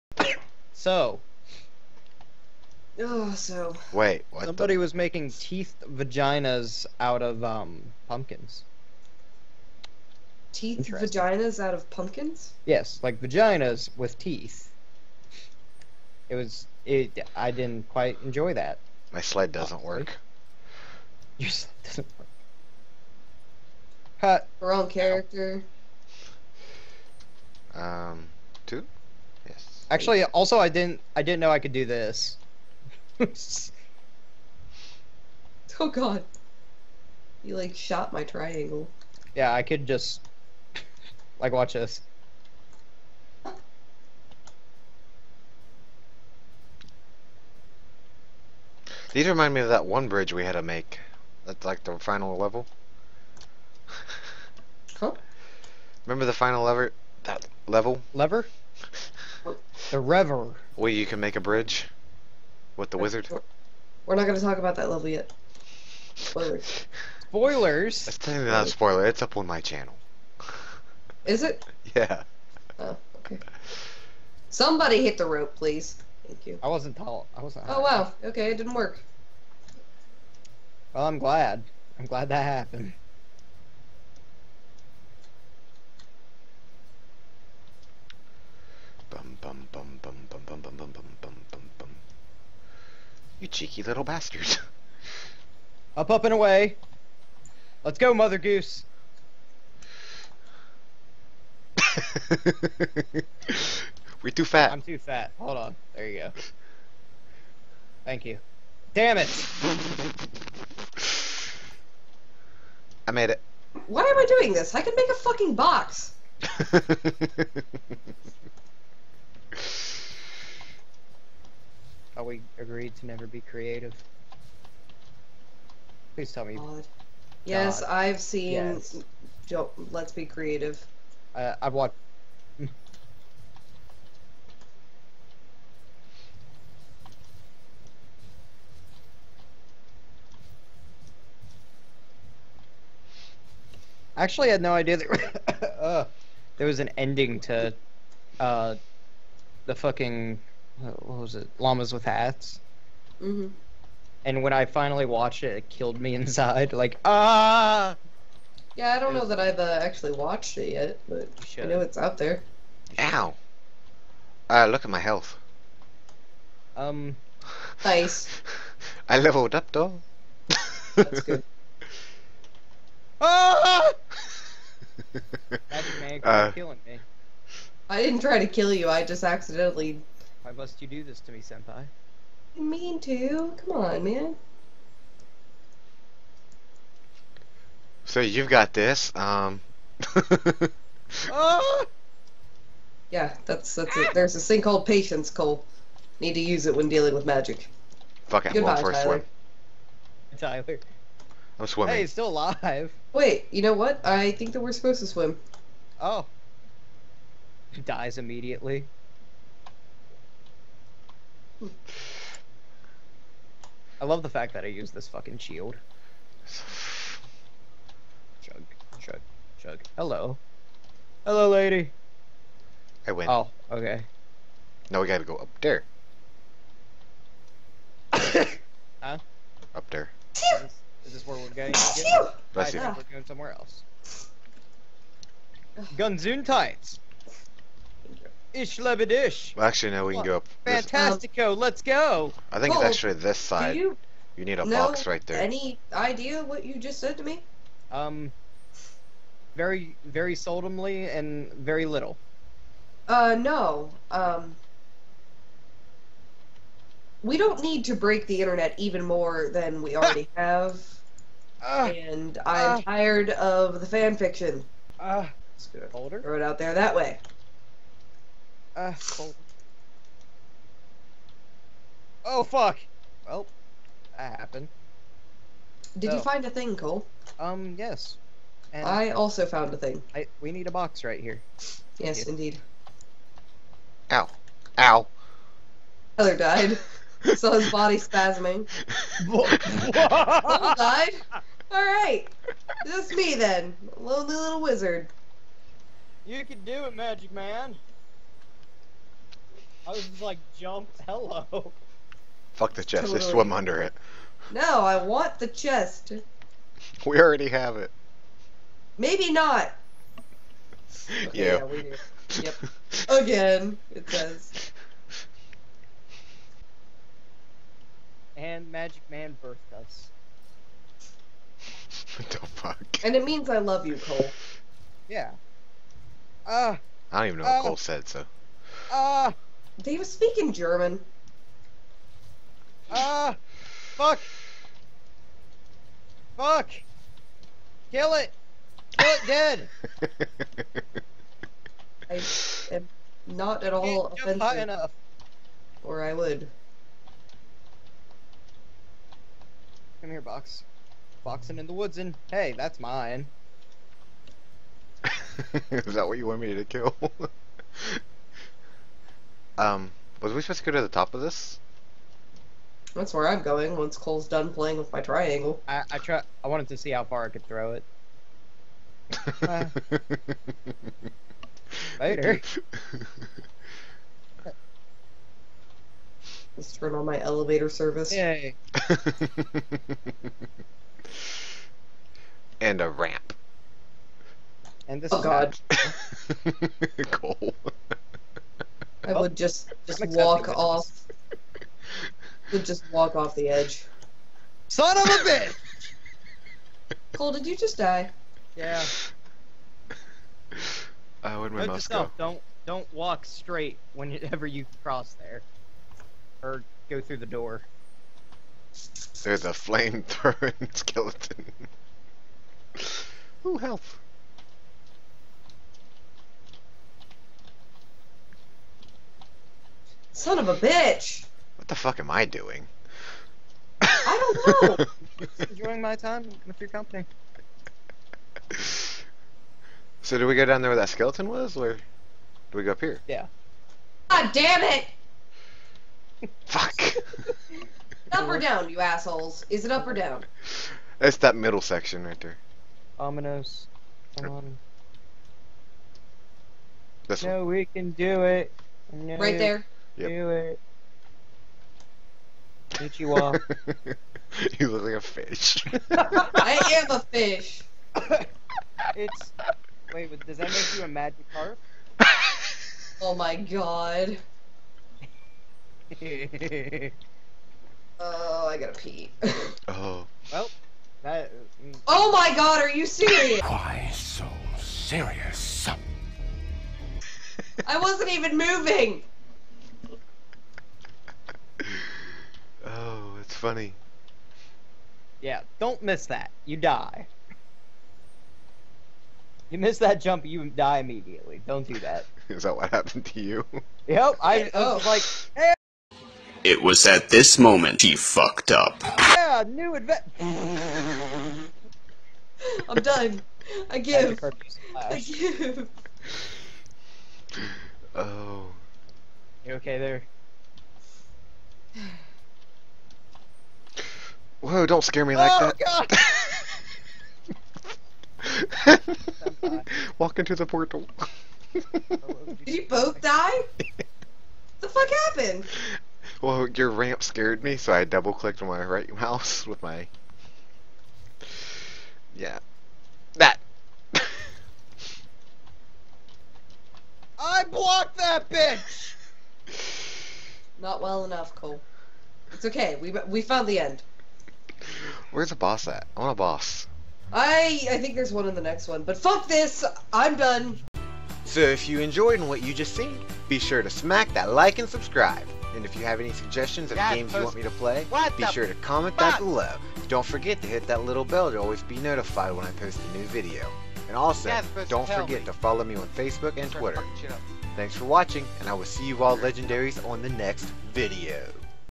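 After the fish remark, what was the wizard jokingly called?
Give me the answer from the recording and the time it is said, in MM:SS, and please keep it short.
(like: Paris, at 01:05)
Magic carp, at 07:40.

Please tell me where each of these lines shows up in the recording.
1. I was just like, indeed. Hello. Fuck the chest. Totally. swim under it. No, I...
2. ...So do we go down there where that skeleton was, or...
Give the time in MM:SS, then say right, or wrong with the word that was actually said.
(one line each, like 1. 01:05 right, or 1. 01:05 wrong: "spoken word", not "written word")
1. 04:59 wrong: "jumped", not "indeed"
2. 07:10 right.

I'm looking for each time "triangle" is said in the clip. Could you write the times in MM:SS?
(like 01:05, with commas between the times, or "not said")
00:38, 06:05.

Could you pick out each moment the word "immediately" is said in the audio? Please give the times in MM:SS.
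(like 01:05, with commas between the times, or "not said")
03:28, 08:10.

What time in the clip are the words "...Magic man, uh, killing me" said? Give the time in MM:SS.
02:55.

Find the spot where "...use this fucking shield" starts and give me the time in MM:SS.
03:34.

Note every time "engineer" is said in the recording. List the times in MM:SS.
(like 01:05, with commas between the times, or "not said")
not said.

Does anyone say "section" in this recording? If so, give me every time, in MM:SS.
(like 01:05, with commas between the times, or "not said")
07:21.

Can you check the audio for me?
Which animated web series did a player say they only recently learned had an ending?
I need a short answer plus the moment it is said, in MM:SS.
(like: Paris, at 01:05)
Llamas with Hats, at 02:31.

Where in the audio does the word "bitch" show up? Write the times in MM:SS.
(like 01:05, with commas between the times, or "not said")
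06:35, 07:00, 08:58.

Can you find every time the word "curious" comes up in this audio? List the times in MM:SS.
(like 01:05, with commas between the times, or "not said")
not said.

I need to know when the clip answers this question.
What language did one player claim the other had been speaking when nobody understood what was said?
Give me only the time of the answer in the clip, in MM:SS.
05:30.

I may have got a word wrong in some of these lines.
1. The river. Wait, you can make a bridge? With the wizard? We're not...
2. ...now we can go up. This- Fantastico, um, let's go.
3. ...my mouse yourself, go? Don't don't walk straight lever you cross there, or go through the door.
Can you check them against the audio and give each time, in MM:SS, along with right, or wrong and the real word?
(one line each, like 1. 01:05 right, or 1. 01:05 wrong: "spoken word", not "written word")
1. 00:59 right
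2. 03:59 right
3. 06:41 wrong: "whenever", not "lever".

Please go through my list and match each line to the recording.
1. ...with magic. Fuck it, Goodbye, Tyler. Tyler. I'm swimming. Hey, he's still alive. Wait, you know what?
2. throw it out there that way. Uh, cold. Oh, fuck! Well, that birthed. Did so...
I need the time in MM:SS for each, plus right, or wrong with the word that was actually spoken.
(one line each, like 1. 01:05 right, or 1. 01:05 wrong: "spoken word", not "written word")
1. 03:17 right
2. 04:26 wrong: "happened", not "birthed".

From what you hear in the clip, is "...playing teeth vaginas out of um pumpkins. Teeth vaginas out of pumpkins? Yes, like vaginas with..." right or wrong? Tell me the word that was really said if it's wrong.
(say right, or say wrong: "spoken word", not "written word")
wrong: "making", not "playing".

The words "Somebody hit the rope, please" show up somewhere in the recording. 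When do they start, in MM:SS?
01:14.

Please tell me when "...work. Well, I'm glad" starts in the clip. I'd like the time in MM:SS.
01:18.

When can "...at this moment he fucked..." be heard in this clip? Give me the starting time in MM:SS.
08:16.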